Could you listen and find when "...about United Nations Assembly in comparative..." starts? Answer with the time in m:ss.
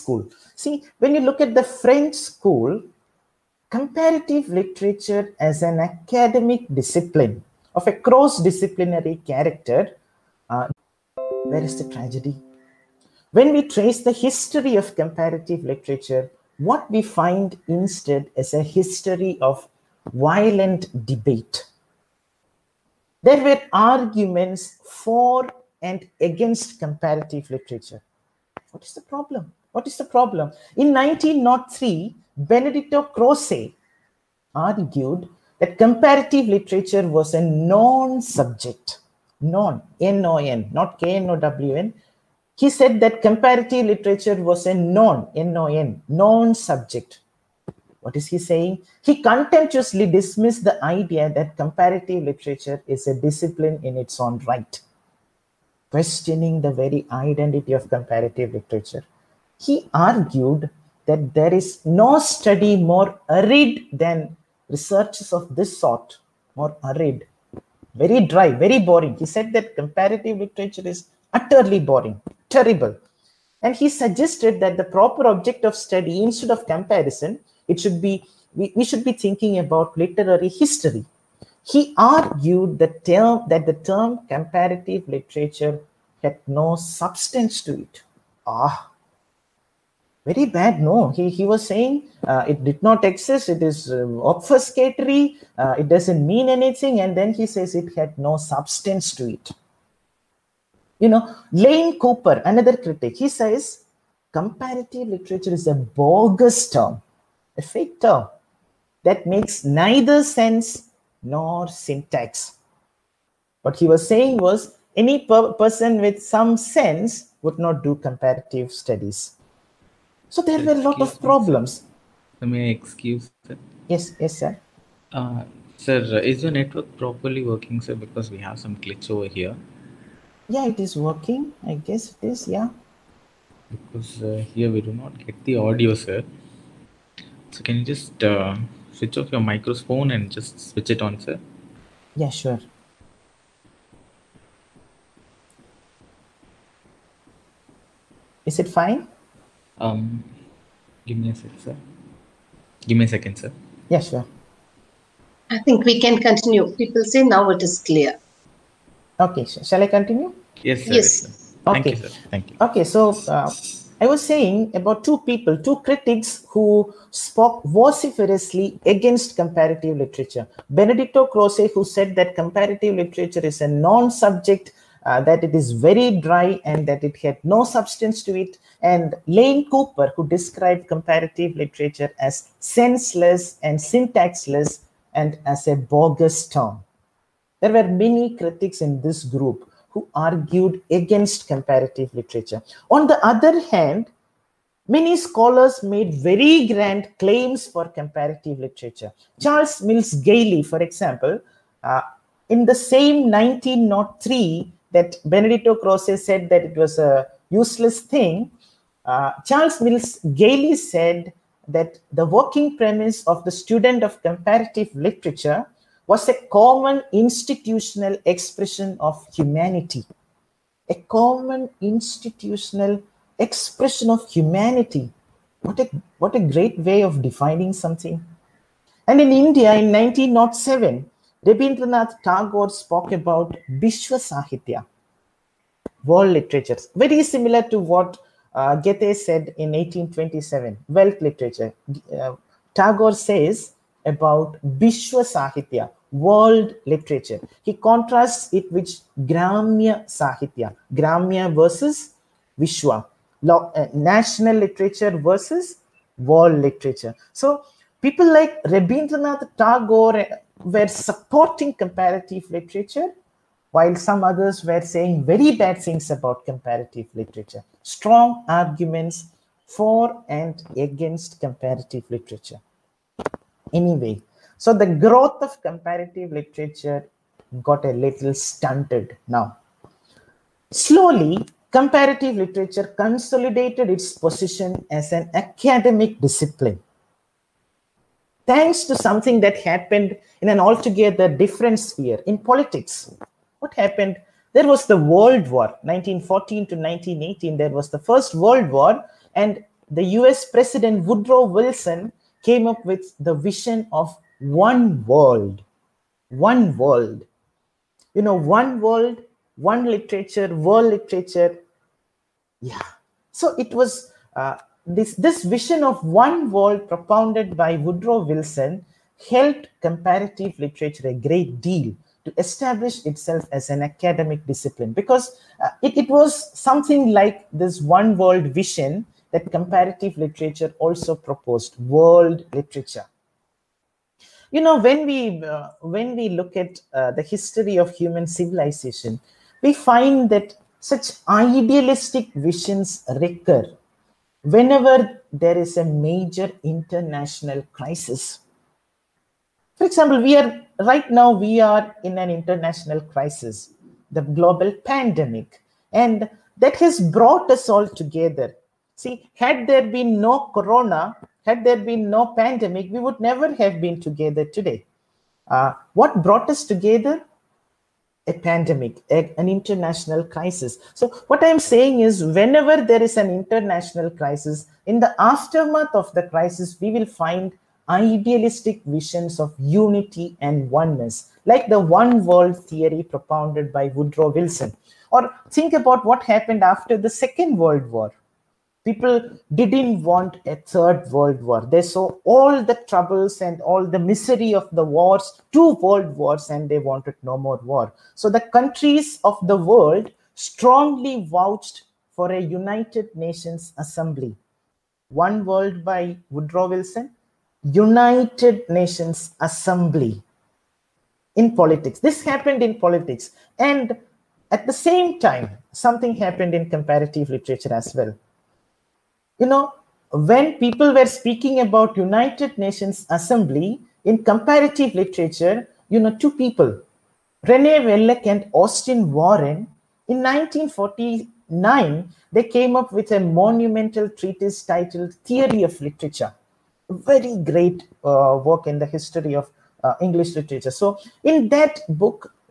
7:01.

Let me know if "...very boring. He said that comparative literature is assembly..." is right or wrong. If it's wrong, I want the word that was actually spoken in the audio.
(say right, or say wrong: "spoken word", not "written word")
wrong: "utterly", not "assembly".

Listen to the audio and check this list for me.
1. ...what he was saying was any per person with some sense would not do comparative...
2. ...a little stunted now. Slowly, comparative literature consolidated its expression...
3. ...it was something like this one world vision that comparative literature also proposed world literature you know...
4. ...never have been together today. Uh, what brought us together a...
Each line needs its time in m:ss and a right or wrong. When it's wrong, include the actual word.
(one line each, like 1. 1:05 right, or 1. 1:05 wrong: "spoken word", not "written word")
1. 1:53 right
2. 4:37 wrong: "position", not "expression"
3. 5:25 right
4. 6:03 right.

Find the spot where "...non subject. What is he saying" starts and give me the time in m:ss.
0:46.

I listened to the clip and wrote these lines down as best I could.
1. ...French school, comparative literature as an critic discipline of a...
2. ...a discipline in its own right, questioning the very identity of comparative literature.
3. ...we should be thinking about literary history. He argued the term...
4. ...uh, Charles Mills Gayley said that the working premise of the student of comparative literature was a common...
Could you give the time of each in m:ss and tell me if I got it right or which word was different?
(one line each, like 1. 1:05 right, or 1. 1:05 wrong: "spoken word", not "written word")
1. 0:01 wrong: "academic", not "critic"
2. 0:53 right
3. 1:18 right
4. 3:29 right.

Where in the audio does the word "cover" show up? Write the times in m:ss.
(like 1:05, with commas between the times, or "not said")
not said.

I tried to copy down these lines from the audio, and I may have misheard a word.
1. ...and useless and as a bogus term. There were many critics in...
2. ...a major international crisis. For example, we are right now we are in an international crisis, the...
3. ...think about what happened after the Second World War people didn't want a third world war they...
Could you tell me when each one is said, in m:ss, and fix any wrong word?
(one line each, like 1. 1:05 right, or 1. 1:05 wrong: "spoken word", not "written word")
1. 3:03 wrong: "syntaxless", not "useless"
2. 5:45 right
3. 6:25 right.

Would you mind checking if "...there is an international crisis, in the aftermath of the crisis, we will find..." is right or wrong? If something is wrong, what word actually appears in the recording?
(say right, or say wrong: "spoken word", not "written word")
right.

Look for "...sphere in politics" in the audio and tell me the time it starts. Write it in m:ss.
4:51.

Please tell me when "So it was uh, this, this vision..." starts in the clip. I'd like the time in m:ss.
5:13.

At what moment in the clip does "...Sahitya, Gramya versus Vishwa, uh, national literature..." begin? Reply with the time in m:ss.
4:10.